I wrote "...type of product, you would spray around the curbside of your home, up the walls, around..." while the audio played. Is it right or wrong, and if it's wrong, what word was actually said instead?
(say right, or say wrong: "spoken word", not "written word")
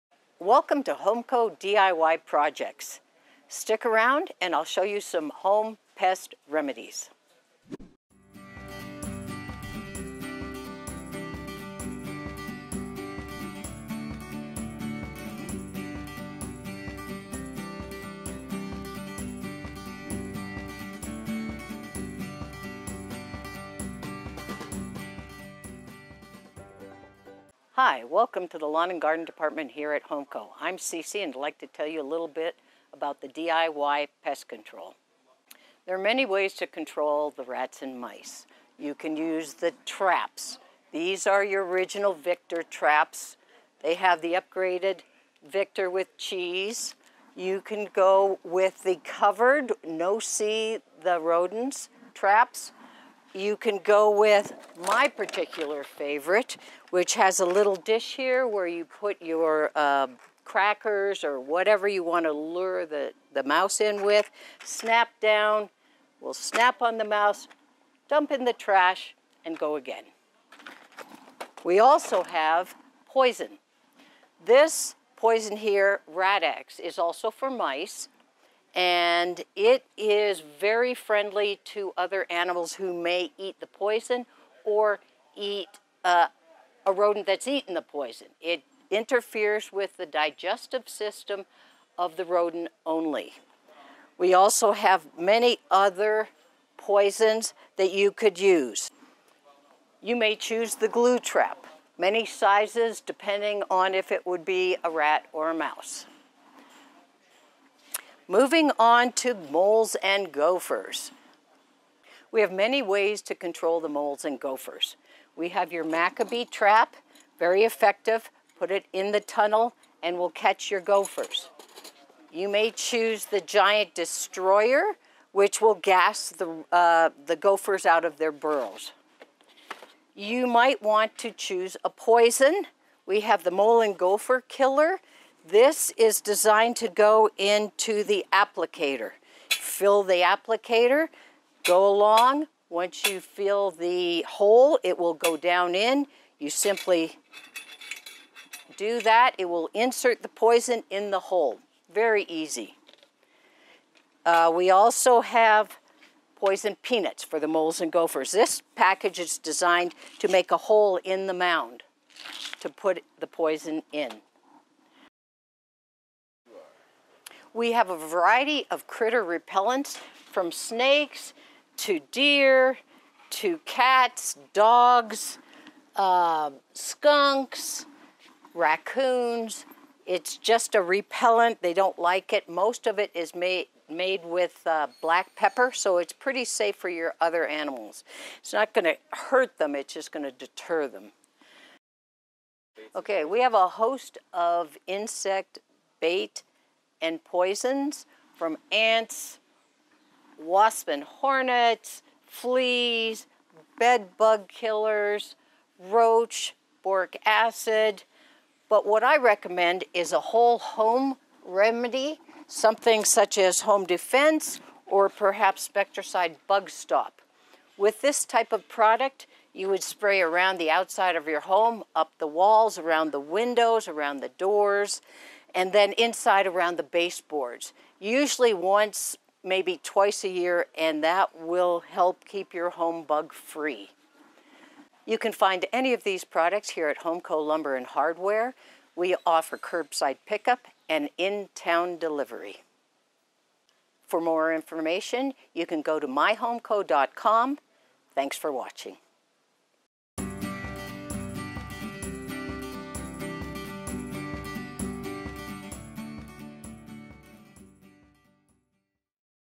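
wrong: "outside", not "curbside".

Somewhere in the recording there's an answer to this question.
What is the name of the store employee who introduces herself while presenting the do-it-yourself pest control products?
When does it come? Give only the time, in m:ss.
0:30.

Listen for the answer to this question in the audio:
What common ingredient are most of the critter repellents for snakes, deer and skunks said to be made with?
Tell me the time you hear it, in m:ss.
3:05.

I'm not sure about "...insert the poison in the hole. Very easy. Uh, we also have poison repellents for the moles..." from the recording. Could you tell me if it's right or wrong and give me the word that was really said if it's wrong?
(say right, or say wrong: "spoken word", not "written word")
wrong: "peanuts", not "repellents".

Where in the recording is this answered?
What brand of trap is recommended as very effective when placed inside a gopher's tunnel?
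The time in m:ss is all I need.
1:55.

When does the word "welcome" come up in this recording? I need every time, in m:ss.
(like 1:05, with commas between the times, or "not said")
0:00, 0:28.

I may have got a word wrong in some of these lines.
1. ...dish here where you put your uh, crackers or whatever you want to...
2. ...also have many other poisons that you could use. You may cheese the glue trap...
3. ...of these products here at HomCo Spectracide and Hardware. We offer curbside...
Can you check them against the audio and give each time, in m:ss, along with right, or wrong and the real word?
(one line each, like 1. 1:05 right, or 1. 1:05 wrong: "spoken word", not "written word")
1. 0:57 right
2. 1:34 wrong: "choose", not "cheese"
3. 3:55 wrong: "Lumber", not "Spectracide".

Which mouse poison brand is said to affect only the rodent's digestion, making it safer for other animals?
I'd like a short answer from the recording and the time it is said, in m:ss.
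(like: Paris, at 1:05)
Radex, at 1:16.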